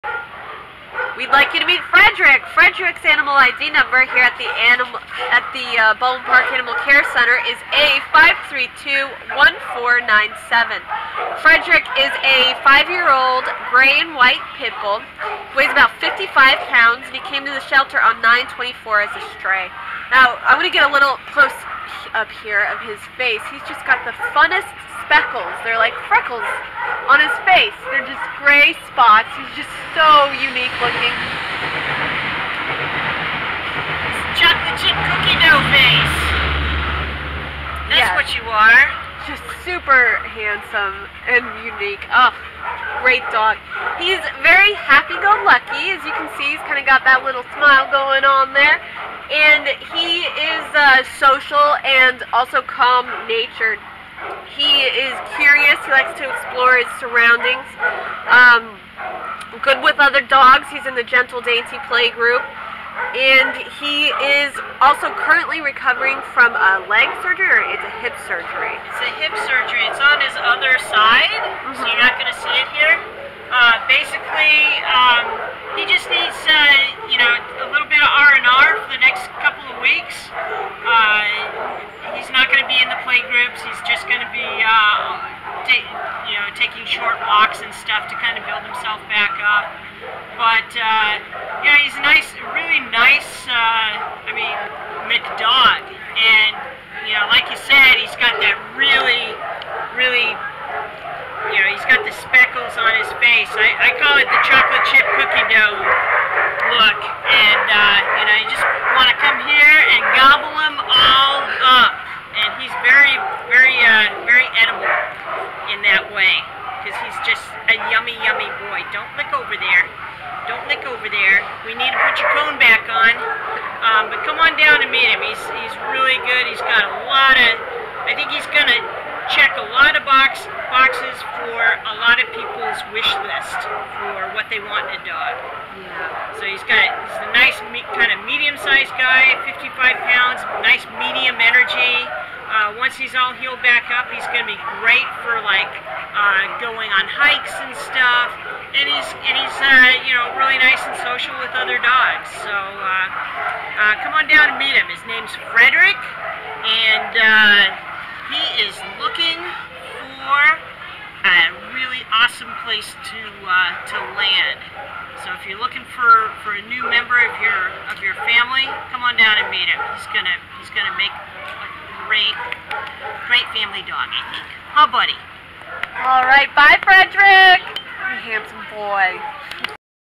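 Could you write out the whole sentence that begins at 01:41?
You know, he's got the speckles on his face.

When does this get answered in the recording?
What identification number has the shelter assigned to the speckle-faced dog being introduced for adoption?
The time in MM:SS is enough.
00:07.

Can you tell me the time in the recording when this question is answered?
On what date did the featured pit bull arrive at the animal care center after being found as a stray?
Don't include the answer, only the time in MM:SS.
00:18.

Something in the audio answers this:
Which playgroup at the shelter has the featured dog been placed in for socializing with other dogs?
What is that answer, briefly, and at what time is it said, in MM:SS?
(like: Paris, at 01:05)
Gentle Dainty Play Group, at 01:01.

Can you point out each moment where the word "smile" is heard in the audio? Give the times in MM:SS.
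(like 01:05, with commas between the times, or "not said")
00:47.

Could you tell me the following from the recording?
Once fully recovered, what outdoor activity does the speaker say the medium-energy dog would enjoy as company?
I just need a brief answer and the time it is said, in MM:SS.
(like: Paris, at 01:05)
hikes, at 02:27.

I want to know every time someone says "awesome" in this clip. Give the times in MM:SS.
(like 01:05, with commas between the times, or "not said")
02:42.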